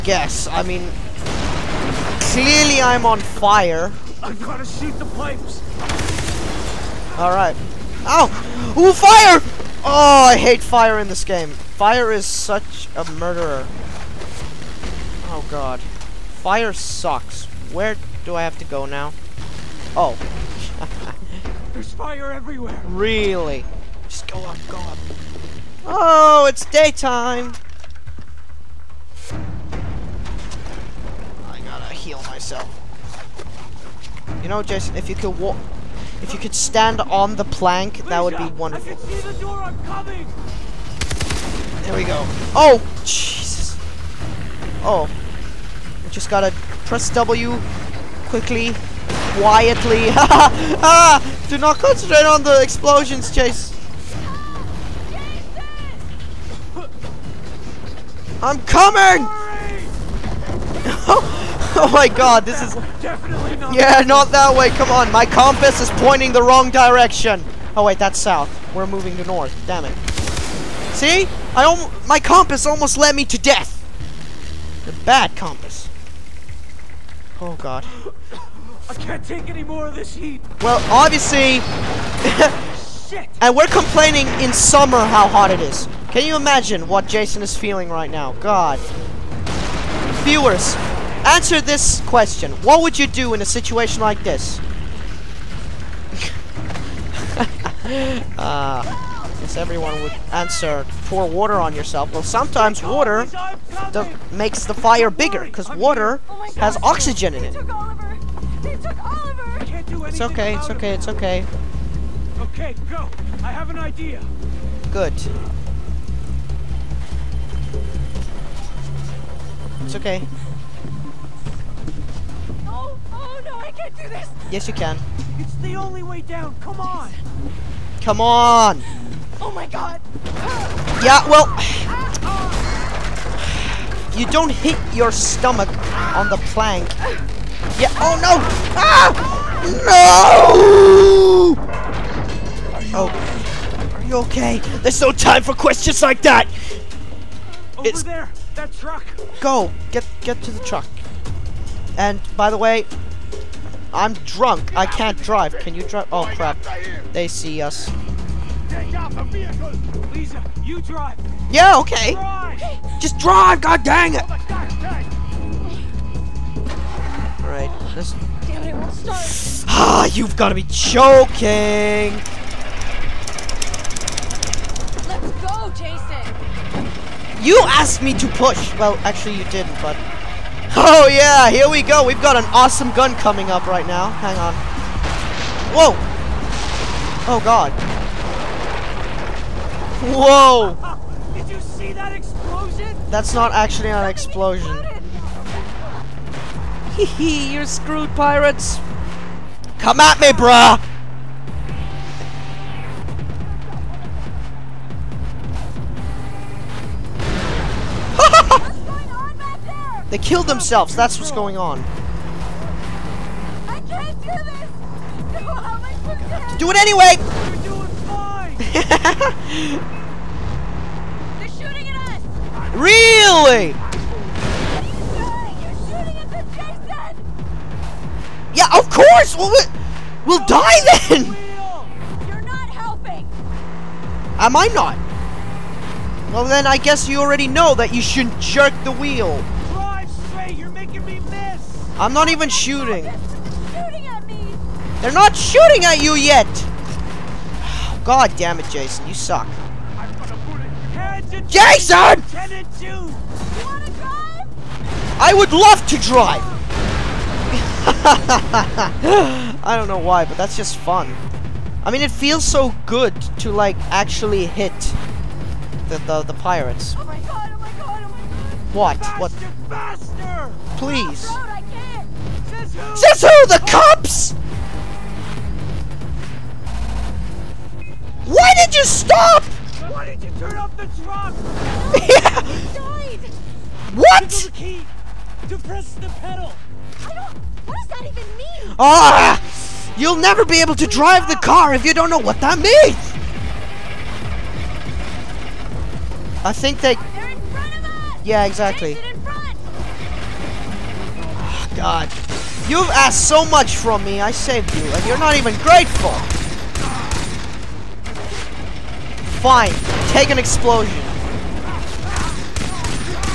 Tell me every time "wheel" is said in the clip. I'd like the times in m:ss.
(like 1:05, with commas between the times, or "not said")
3:58.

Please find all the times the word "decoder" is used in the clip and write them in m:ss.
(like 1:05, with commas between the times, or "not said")
not said.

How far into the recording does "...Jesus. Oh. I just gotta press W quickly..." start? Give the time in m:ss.
0:43.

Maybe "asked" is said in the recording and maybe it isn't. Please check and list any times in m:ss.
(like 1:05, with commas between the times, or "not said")
2:57, 5:02.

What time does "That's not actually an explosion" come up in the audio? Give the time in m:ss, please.
3:13.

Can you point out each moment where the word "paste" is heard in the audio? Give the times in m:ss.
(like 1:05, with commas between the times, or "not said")
not said.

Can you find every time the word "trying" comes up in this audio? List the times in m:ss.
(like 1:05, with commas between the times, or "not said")
not said.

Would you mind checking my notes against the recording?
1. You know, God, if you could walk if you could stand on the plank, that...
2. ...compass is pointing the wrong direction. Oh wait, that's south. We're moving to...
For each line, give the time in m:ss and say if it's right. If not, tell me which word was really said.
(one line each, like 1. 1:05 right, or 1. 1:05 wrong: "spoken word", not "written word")
1. 0:34 wrong: "Jason", not "God"
2. 1:05 right.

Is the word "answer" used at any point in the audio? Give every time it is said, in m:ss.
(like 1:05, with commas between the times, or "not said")
1:31, 1:40.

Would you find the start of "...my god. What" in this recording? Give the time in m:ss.
4:28.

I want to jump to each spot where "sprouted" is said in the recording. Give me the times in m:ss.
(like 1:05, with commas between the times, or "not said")
not said.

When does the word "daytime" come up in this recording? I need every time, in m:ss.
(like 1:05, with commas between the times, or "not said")
0:26.